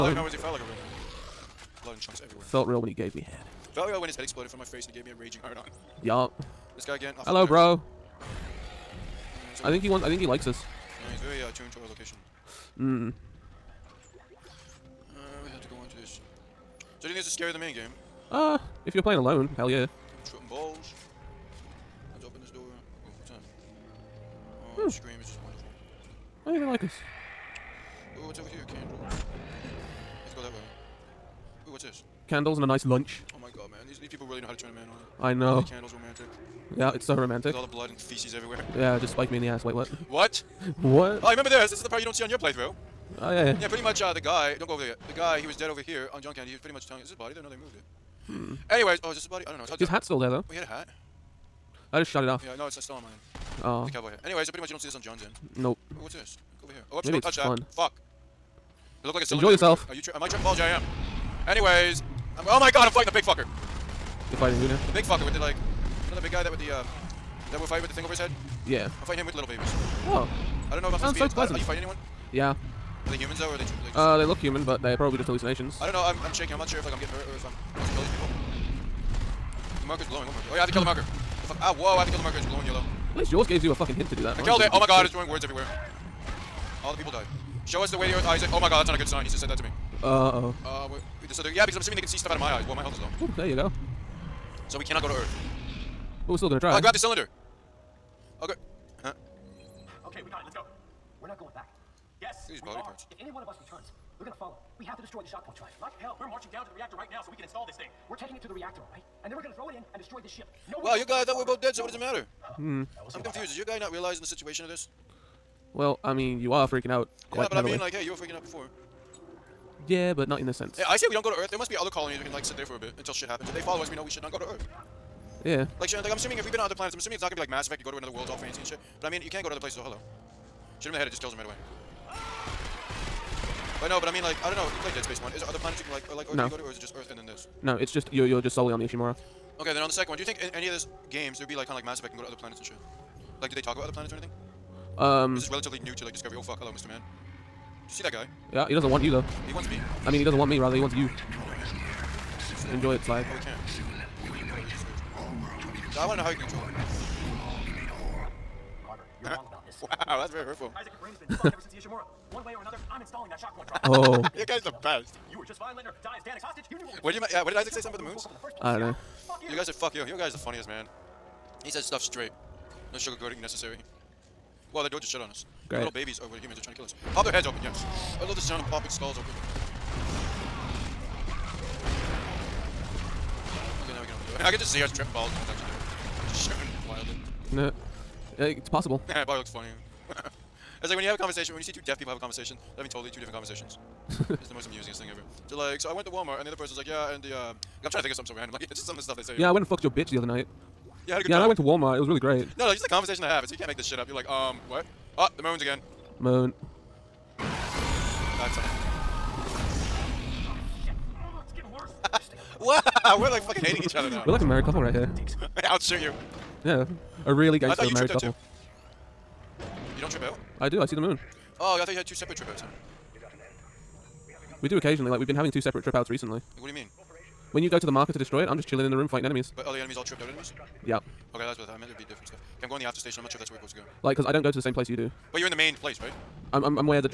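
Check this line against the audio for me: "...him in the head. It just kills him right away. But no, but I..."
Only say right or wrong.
right.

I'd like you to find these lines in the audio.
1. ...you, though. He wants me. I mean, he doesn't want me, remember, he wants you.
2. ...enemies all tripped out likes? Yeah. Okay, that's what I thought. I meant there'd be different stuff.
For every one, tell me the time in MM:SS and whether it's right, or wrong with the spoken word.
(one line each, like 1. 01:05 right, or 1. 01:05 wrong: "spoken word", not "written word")
1. 02:29 wrong: "rather", not "remember"
2. 03:49 wrong: "enemies", not "likes".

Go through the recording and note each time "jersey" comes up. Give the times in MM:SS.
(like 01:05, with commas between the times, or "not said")
not said.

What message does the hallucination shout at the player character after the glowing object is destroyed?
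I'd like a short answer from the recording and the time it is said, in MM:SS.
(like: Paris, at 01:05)
Show us the way to Earth, Isaac, at 01:27.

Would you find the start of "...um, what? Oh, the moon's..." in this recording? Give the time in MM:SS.
03:24.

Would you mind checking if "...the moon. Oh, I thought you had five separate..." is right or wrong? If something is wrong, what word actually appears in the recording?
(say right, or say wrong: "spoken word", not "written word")
wrong: "two", not "five".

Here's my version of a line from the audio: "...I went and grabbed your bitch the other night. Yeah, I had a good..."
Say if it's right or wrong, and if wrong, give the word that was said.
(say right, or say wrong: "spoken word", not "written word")
wrong: "fucked", not "grabbed".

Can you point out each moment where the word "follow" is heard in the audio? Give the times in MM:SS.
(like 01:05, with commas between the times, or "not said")
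01:44, 02:03.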